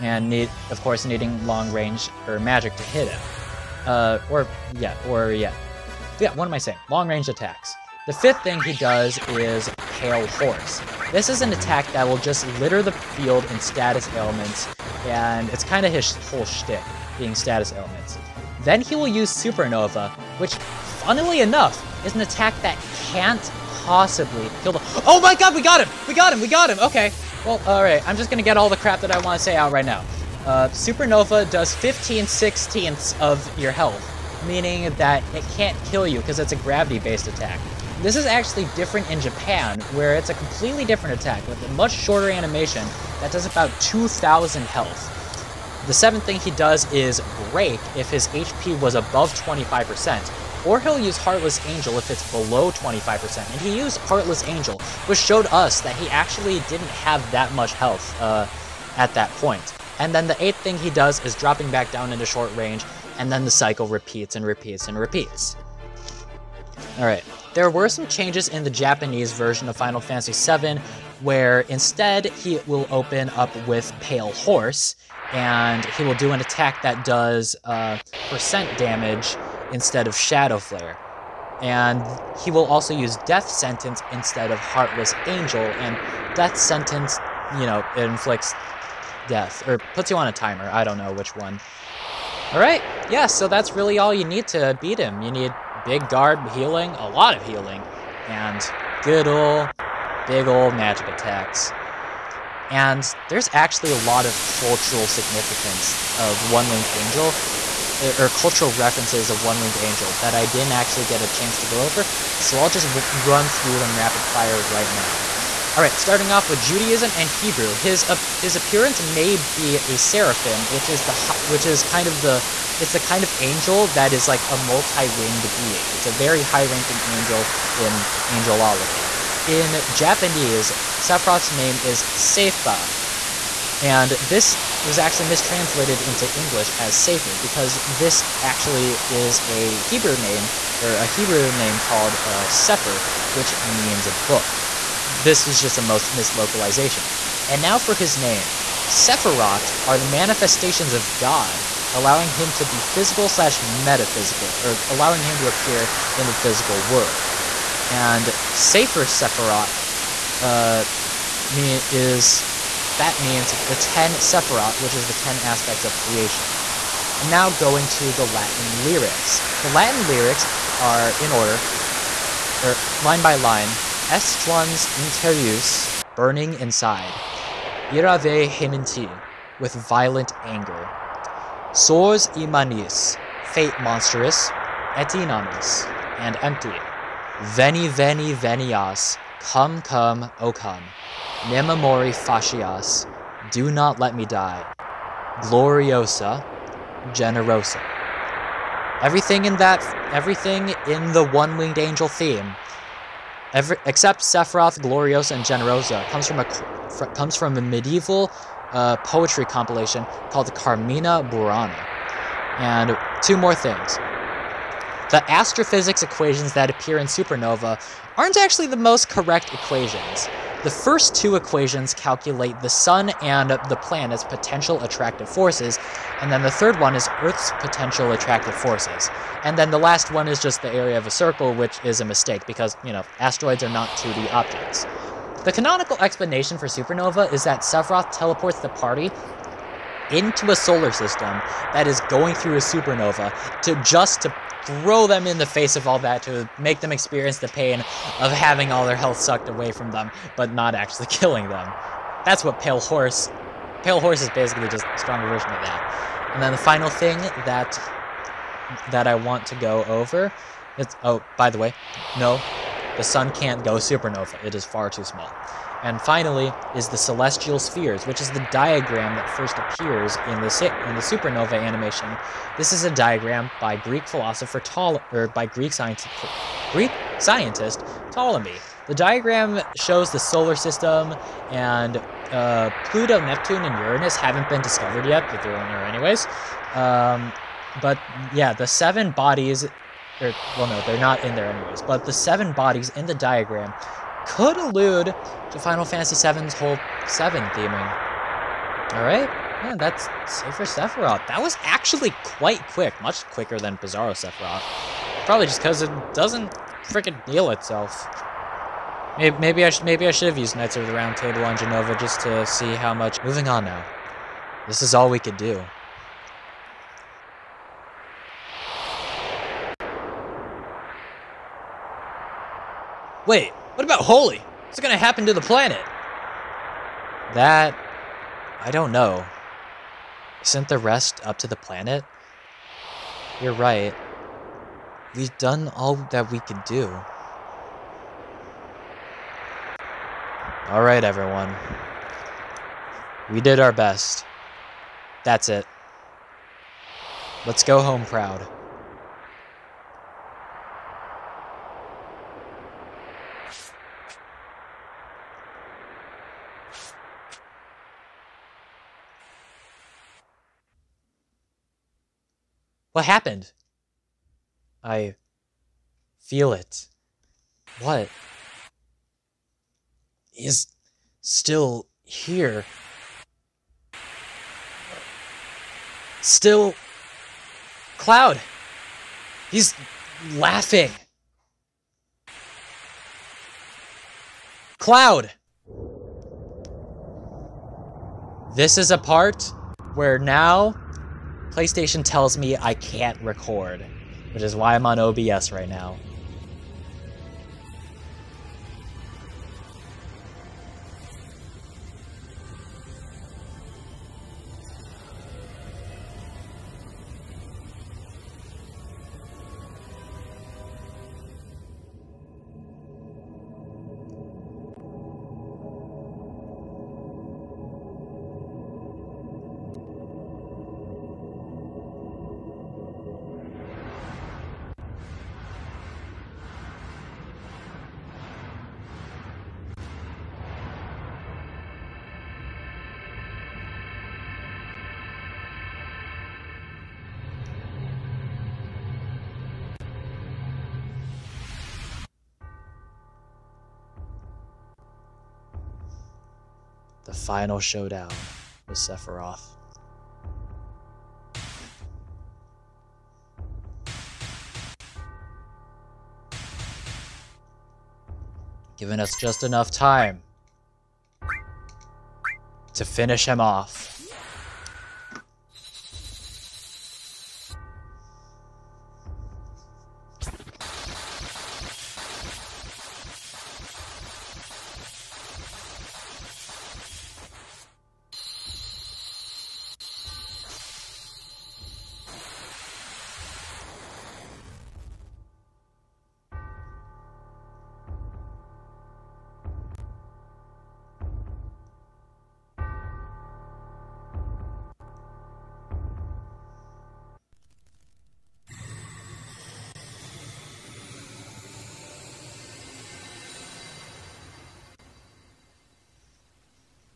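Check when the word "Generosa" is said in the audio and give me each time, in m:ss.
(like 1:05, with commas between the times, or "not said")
3:17, 3:25.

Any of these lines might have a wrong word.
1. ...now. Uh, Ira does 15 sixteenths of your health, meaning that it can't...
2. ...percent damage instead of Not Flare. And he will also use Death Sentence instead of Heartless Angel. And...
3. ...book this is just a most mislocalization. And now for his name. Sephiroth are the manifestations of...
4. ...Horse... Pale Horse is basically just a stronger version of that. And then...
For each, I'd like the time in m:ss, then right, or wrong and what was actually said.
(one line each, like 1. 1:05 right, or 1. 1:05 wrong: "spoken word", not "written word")
1. 0:29 wrong: "Supernova", not "Ira"
2. 1:18 wrong: "Shadow", not "Not"
3. 2:24 right
4. 4:12 right.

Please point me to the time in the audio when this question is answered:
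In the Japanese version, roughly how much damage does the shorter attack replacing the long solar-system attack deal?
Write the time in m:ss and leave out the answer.
0:43.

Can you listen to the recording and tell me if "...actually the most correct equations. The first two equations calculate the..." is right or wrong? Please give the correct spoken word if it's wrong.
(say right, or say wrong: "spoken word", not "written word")
right.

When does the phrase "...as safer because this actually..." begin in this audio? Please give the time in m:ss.
2:16.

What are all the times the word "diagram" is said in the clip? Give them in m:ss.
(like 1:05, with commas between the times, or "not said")
4:28, 4:32, 4:38, 4:53.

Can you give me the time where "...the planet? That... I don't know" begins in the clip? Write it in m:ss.
5:25.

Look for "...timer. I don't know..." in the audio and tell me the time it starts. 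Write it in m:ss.
1:30.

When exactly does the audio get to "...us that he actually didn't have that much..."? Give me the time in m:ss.
0:55.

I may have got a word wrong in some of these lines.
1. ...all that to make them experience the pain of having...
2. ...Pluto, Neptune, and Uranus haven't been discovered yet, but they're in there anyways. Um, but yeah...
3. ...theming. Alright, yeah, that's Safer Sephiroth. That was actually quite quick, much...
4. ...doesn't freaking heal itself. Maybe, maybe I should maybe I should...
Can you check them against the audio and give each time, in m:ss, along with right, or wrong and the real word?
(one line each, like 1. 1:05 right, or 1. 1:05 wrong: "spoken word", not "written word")
1. 4:05 right
2. 4:42 right
3. 4:57 right
4. 5:06 right.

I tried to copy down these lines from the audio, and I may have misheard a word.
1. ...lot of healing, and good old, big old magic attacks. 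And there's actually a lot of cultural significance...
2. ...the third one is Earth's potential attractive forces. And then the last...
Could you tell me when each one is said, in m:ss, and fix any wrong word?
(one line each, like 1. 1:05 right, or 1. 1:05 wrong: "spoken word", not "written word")
1. 1:37 right
2. 3:46 right.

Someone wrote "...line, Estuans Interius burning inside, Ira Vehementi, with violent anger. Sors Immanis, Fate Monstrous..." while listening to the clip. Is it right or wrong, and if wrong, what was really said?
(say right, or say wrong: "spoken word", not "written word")
right.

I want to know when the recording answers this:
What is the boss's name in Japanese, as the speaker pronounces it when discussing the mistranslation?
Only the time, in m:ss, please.
2:12.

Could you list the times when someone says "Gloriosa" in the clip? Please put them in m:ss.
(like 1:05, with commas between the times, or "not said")
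3:15, 3:24.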